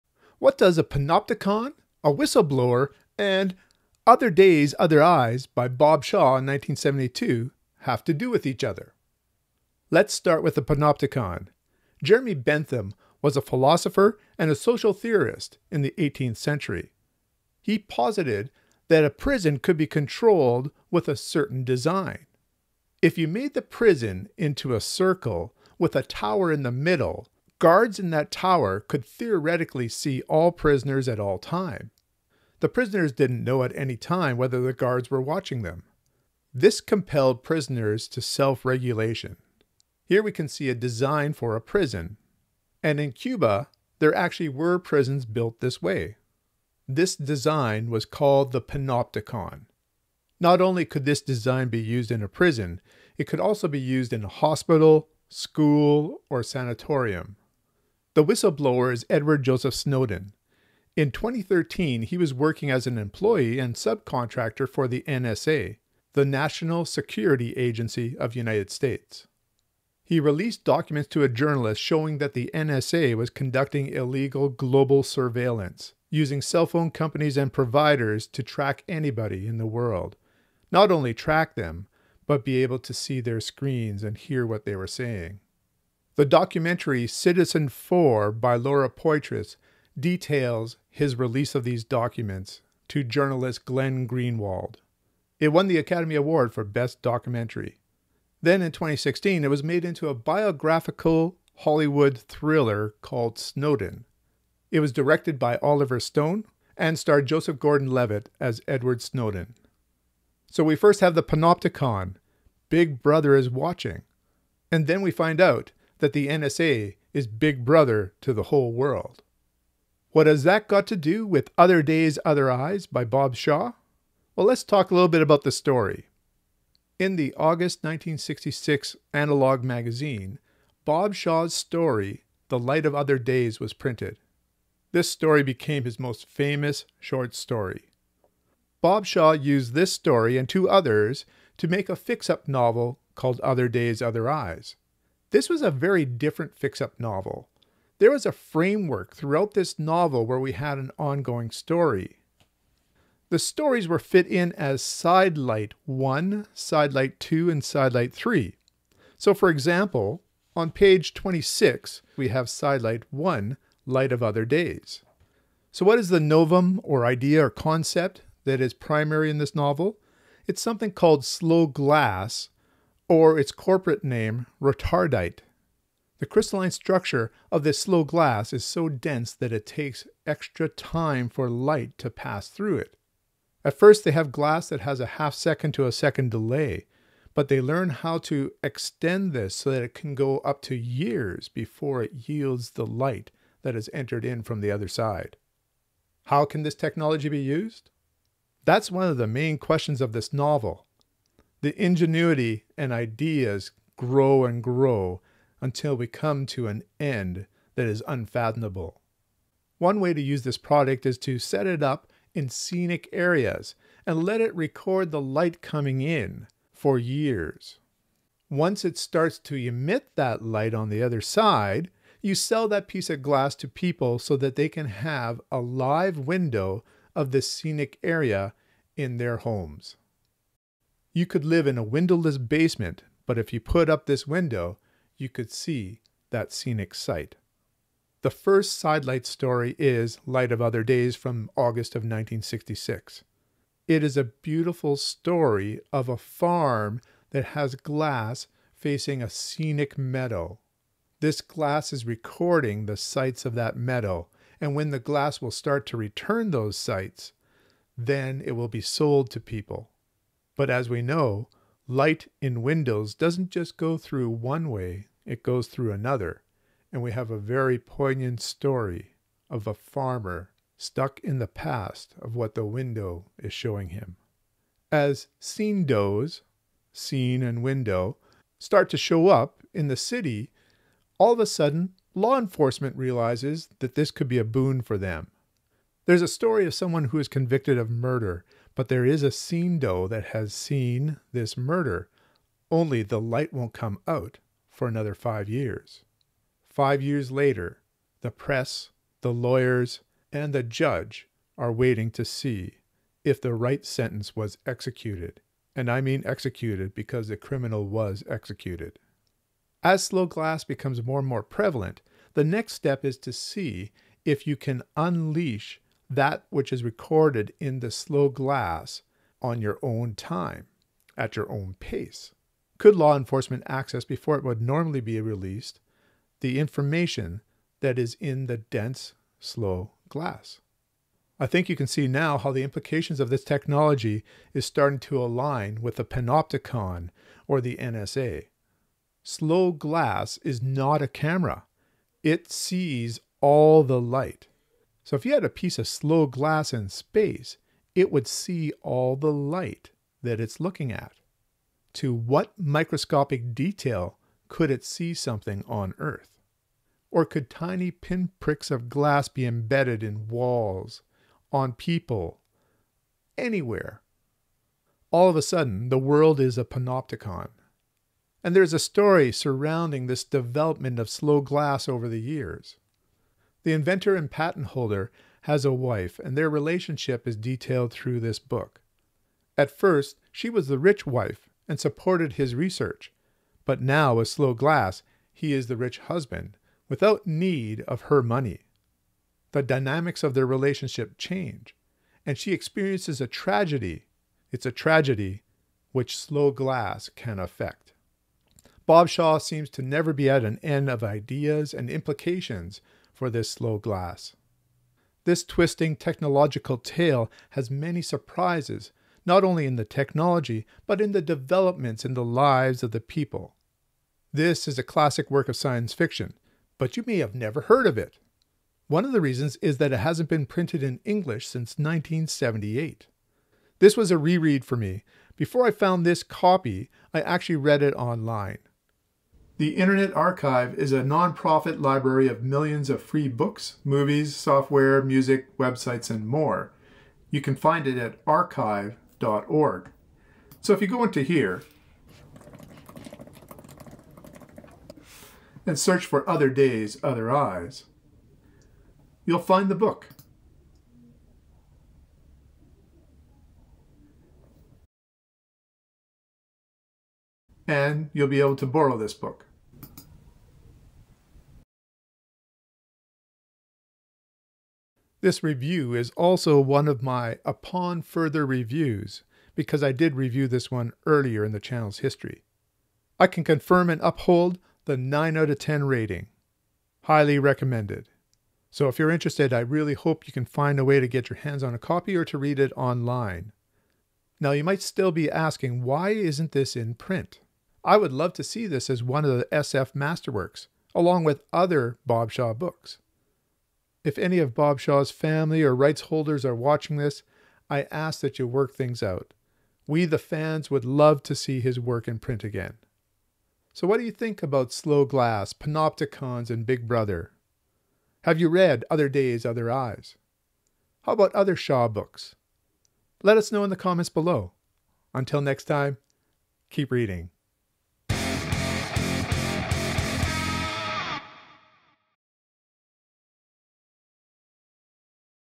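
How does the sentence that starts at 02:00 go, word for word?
What has that got to do with Other Days, Other Eyes by Bob Shaw?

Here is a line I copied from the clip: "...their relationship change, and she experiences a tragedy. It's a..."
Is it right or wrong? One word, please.
right.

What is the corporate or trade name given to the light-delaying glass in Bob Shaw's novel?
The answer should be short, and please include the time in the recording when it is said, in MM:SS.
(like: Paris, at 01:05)
Retardite, at 02:54.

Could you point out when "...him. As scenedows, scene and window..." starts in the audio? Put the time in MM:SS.
04:33.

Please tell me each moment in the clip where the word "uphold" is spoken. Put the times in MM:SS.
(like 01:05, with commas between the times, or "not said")
07:54.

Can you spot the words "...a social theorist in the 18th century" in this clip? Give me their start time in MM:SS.
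00:14.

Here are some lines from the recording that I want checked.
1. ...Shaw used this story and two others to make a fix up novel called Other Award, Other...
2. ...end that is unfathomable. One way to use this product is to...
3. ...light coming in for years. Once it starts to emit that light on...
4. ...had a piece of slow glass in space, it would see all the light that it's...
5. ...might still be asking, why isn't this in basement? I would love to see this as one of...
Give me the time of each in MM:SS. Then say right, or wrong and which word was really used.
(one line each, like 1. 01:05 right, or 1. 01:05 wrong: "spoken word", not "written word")
1. 02:19 wrong: "Days", not "Award"
2. 03:26 right
3. 03:35 right
4. 05:45 right
5. 08:04 wrong: "print", not "basement".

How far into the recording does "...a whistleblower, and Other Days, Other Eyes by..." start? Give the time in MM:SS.
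00:02.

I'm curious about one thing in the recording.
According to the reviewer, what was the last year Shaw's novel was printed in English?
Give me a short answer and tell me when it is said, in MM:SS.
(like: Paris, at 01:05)
1978, at 07:01.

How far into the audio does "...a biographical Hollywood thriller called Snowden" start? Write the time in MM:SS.
01:40.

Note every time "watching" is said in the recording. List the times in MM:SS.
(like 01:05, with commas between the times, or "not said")
00:35, 01:53, 08:16.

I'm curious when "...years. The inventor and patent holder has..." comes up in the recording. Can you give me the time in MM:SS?
06:12.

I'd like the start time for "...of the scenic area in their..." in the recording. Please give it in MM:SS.
03:47.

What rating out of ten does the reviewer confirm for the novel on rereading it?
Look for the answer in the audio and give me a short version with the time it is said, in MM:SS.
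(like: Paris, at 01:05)
9, at 07:54.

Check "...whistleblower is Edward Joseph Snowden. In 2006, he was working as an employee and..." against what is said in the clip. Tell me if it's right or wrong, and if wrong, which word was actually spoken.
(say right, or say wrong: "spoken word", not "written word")
wrong: "2013", not "2006".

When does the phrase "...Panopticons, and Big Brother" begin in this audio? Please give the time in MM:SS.
08:25.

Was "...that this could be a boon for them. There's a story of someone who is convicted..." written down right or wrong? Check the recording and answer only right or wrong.
right.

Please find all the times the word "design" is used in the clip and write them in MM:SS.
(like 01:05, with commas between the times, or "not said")
00:21, 00:40, 00:47, 00:51.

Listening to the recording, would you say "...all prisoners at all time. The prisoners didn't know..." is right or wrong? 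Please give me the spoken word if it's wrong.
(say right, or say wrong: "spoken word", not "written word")
right.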